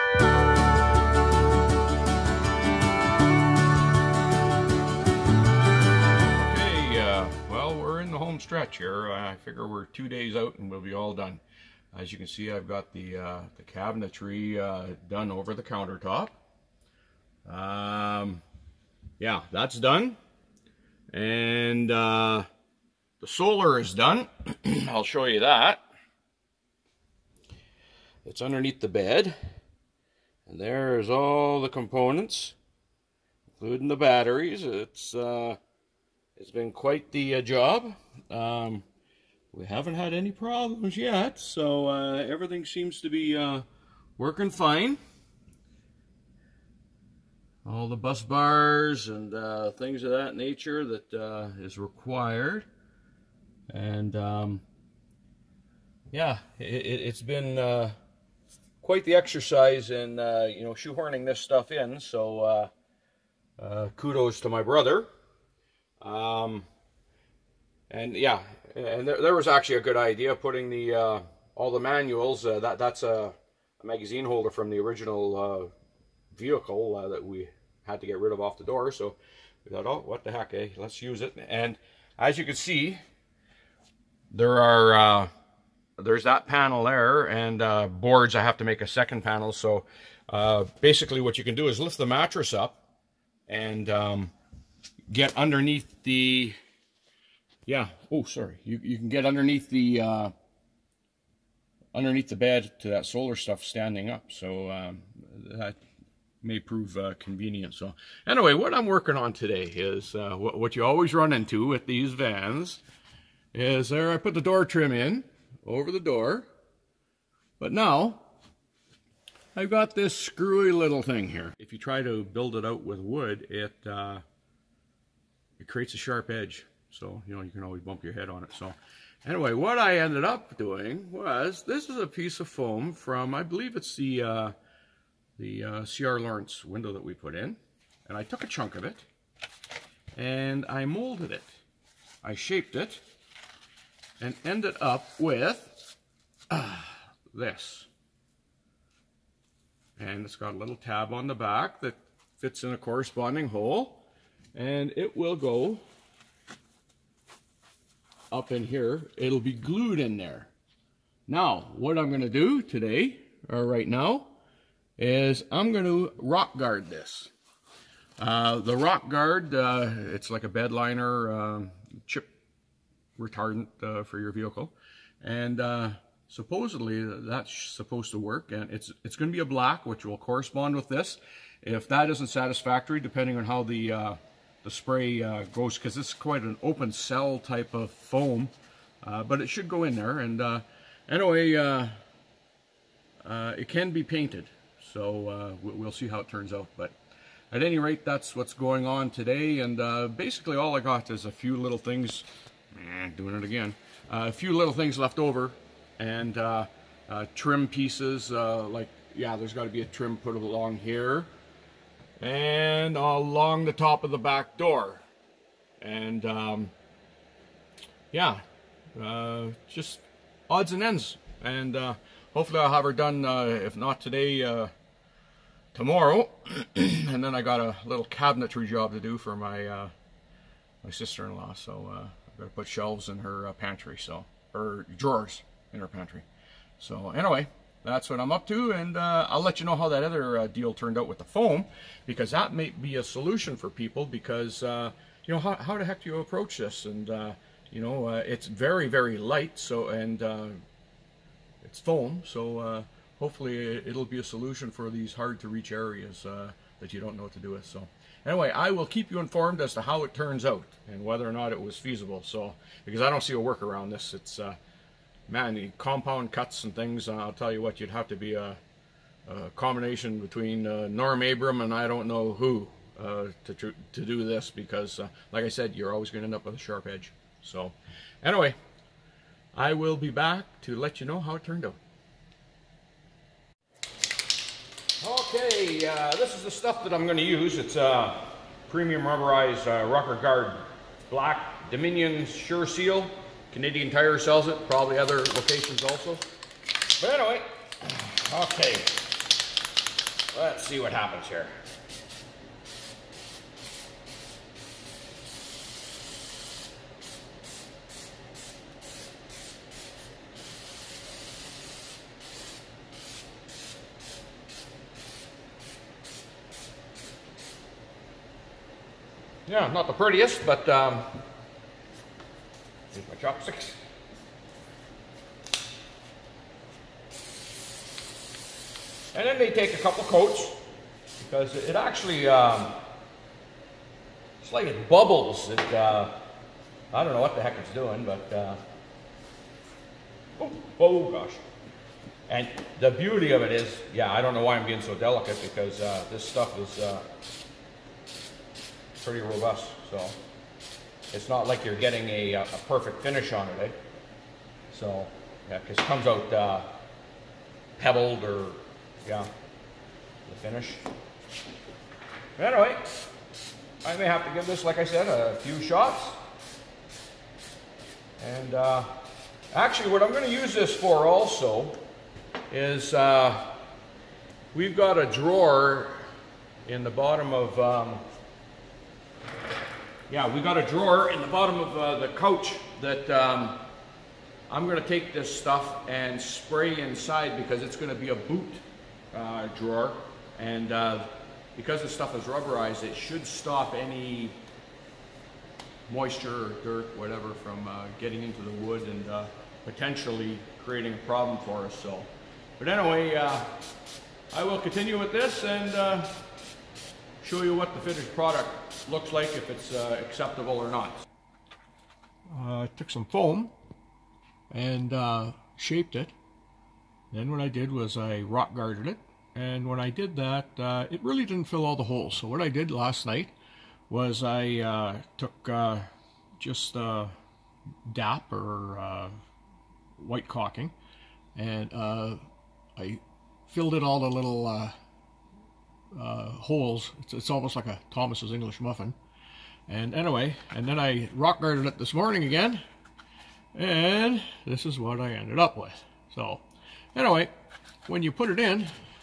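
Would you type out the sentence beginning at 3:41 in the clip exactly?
And uh, hopefully I'll have her done, uh, if not today, uh, tomorrow.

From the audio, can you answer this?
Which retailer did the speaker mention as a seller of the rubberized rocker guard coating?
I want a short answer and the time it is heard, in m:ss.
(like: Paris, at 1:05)
Canadian Tire, at 4:53.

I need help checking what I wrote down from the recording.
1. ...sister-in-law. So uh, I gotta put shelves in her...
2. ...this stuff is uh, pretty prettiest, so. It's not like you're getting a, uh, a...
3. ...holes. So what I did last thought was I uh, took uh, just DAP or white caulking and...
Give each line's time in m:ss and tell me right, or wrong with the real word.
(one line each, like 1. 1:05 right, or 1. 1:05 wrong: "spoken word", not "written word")
1. 3:50 right
2. 5:46 wrong: "robust", not "prettiest"
3. 7:01 wrong: "night", not "thought".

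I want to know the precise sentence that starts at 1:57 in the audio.
But now I've got this screwy little thing here.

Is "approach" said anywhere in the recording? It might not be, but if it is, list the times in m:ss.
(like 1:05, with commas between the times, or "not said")
4:06.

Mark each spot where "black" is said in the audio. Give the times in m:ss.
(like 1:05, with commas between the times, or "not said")
2:59, 4:51.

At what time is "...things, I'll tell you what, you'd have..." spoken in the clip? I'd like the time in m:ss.
4:26.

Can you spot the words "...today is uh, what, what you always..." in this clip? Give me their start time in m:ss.
1:49.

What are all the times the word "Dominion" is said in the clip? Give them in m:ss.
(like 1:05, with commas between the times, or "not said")
4:51.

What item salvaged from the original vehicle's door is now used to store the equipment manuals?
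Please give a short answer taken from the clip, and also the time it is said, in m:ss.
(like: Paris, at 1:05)
Magazine holder, at 1:13.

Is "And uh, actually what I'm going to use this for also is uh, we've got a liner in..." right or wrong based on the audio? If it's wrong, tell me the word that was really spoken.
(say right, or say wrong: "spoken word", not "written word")
wrong: "drawer", not "liner".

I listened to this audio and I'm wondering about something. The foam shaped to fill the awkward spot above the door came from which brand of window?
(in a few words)
C.R. Laurence.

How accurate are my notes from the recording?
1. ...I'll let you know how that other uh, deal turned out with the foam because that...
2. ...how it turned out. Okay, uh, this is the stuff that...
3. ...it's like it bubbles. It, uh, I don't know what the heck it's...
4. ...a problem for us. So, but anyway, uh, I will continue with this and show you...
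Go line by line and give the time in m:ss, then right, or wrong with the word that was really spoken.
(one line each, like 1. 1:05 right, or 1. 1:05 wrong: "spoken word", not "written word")
1. 3:59 right
2. 4:41 right
3. 5:34 right
4. 6:40 right.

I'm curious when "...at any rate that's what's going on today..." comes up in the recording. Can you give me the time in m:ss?
3:17.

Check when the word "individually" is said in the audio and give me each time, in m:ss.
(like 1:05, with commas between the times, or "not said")
not said.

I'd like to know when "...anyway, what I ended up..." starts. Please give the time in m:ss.
2:09.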